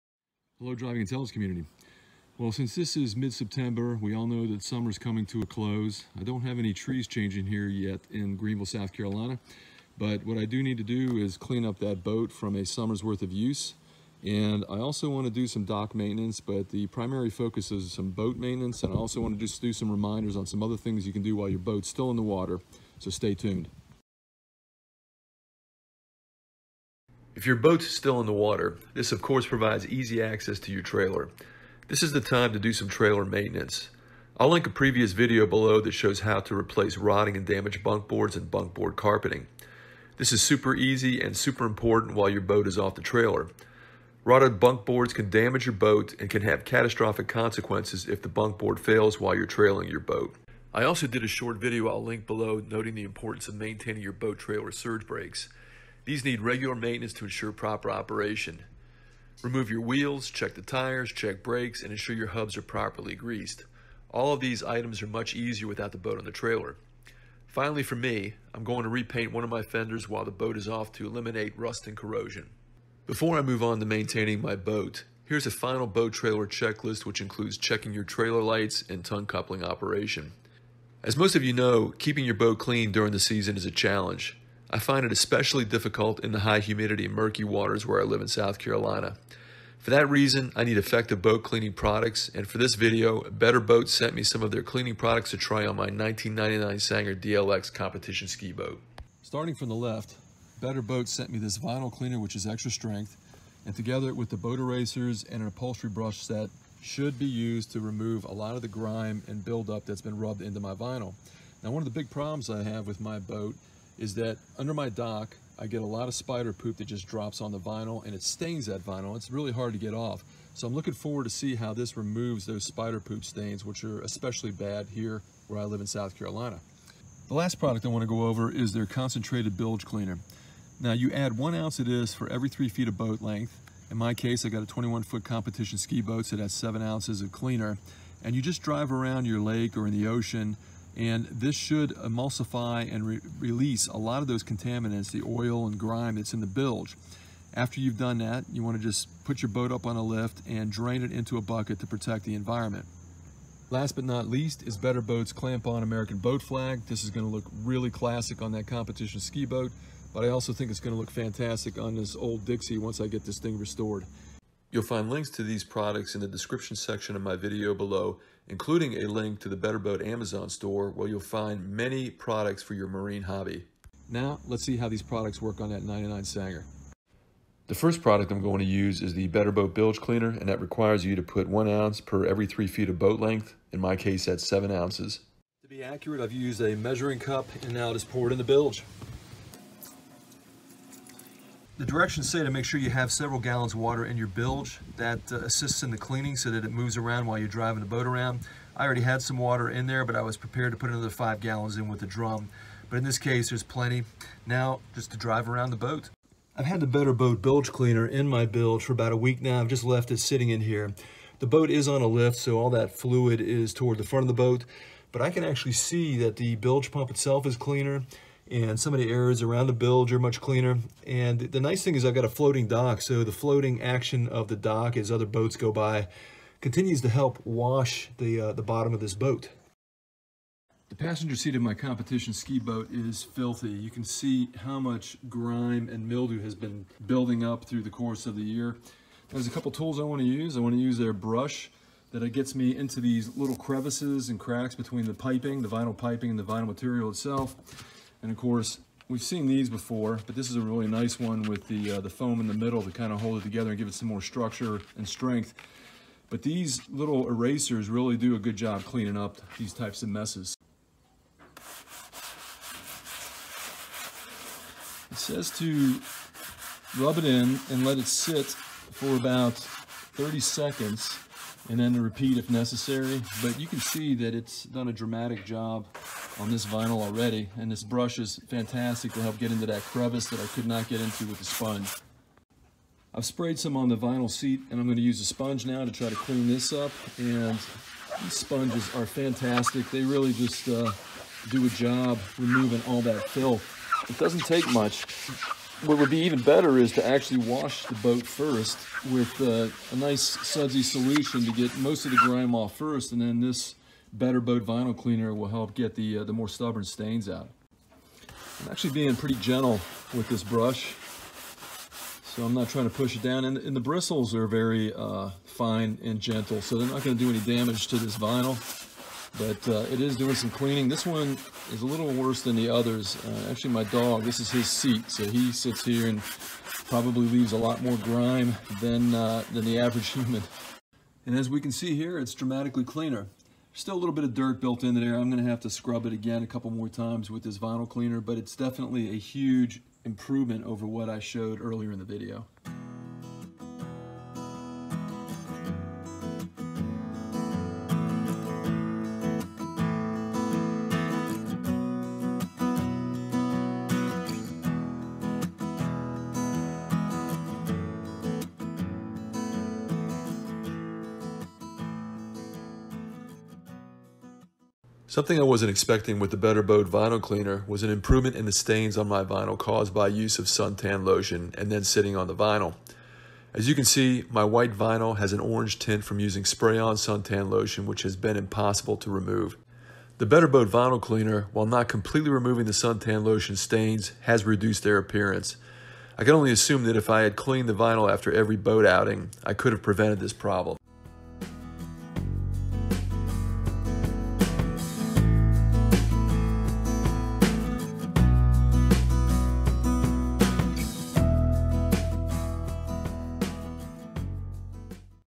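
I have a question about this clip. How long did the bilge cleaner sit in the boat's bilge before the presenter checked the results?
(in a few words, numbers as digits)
About a week.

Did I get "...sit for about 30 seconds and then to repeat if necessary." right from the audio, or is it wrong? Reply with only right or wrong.
right.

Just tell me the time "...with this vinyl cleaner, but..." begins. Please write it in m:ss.
5:37.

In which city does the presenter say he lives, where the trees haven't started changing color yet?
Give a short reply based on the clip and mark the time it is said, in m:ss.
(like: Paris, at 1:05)
Greenville, South Carolina, at 0:08.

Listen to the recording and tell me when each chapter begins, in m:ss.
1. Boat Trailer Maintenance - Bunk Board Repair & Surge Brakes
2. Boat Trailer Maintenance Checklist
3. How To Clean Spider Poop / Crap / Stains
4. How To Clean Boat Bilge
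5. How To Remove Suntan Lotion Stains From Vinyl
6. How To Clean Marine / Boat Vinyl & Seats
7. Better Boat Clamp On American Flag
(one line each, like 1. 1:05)
1. 0:25
2. 1:12
3. 1:56
4. 2:56
5. 6:04
6. 3:50
7. 6:31.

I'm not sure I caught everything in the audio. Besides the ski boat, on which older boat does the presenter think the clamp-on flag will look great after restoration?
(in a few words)
Old Dixie.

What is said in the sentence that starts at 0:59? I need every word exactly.
Remove your wheels, check the tires, check brakes, and ensure your hubs are properly greased.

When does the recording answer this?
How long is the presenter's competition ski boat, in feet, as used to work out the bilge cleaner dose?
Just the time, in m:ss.
2:14.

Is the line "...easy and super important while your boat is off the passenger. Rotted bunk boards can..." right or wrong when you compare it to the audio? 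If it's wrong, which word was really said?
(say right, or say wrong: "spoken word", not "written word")
wrong: "trailer", not "passenger".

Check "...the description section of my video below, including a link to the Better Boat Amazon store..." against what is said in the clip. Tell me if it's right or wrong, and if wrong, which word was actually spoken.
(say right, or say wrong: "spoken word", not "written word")
right.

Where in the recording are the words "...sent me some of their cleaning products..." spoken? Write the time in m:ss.
1:33.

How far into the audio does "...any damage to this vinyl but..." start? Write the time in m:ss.
5:17.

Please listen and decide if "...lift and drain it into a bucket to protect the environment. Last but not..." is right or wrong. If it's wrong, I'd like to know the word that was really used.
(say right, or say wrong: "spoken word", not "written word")
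right.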